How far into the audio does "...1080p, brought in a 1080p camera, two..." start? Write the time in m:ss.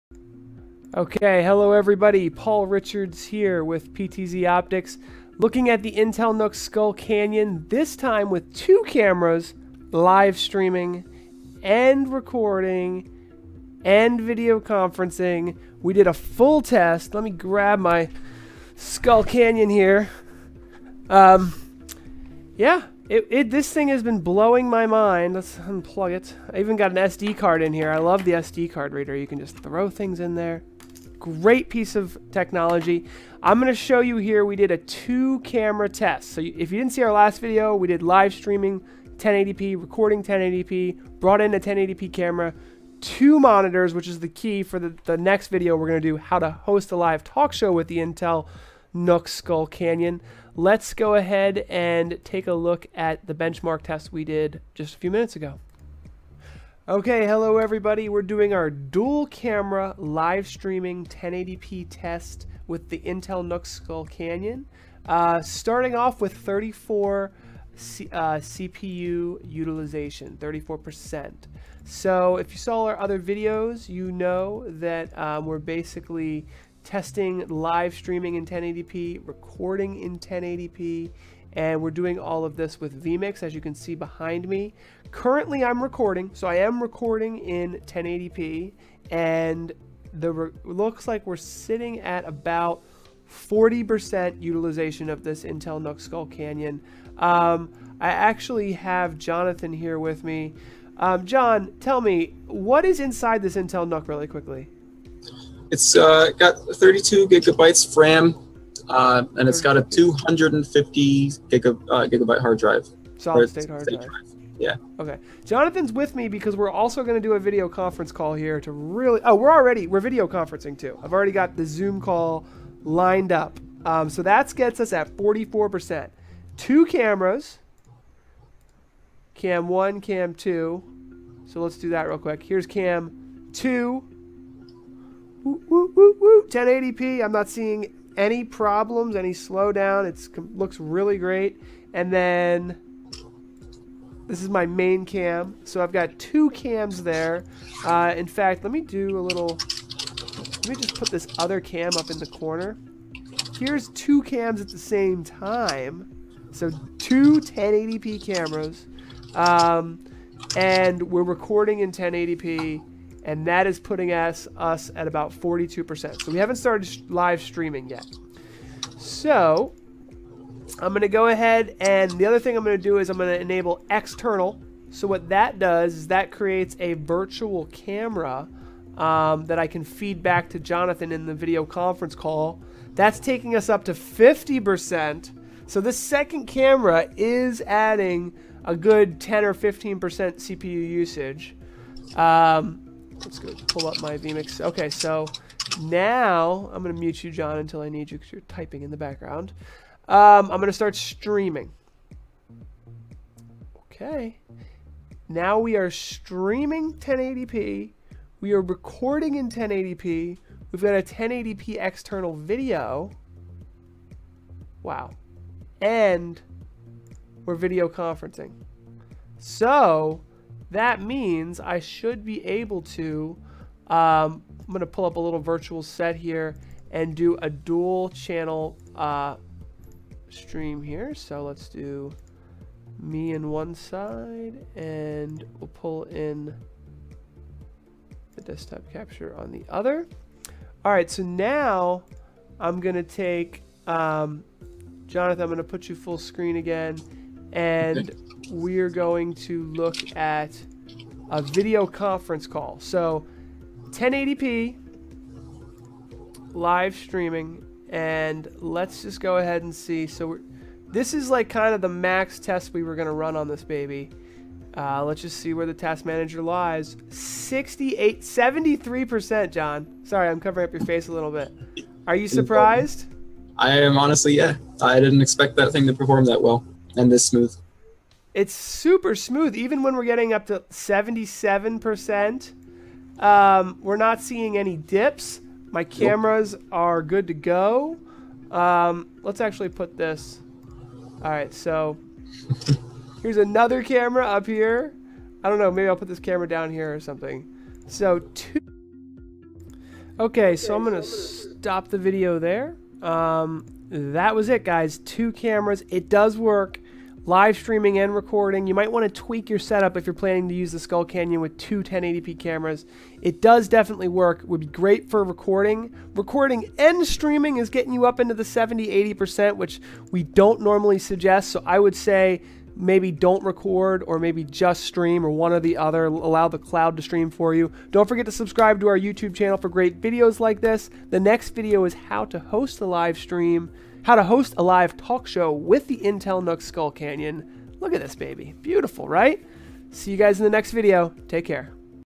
0:40.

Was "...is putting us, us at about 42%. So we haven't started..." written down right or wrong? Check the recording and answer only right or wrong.
right.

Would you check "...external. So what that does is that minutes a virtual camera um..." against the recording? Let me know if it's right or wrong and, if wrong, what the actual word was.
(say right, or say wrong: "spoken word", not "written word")
wrong: "creates", not "minutes".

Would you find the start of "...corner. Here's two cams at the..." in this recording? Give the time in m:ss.
2:32.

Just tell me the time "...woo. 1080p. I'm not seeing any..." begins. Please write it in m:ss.
2:16.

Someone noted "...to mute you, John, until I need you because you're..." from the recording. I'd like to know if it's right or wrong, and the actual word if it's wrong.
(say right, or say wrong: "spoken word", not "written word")
right.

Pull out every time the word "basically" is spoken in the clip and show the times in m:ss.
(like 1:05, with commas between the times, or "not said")
1:15.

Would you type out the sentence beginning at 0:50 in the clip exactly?
Let's go ahead and take a look at the benchmark test we did just a few minutes ago.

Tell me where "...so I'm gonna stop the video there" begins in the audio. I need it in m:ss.
5:00.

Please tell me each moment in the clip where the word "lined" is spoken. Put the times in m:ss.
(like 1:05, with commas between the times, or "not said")
2:02.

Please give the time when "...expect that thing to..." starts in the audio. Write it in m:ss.
4:35.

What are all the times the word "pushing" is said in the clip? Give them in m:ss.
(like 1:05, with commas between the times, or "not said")
not said.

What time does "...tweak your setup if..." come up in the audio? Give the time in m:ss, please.
5:09.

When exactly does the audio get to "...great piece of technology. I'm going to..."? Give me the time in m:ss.
0:31.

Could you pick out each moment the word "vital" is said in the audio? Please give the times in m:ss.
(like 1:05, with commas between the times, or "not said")
not said.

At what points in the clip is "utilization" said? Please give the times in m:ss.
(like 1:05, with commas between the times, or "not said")
1:09, 1:34.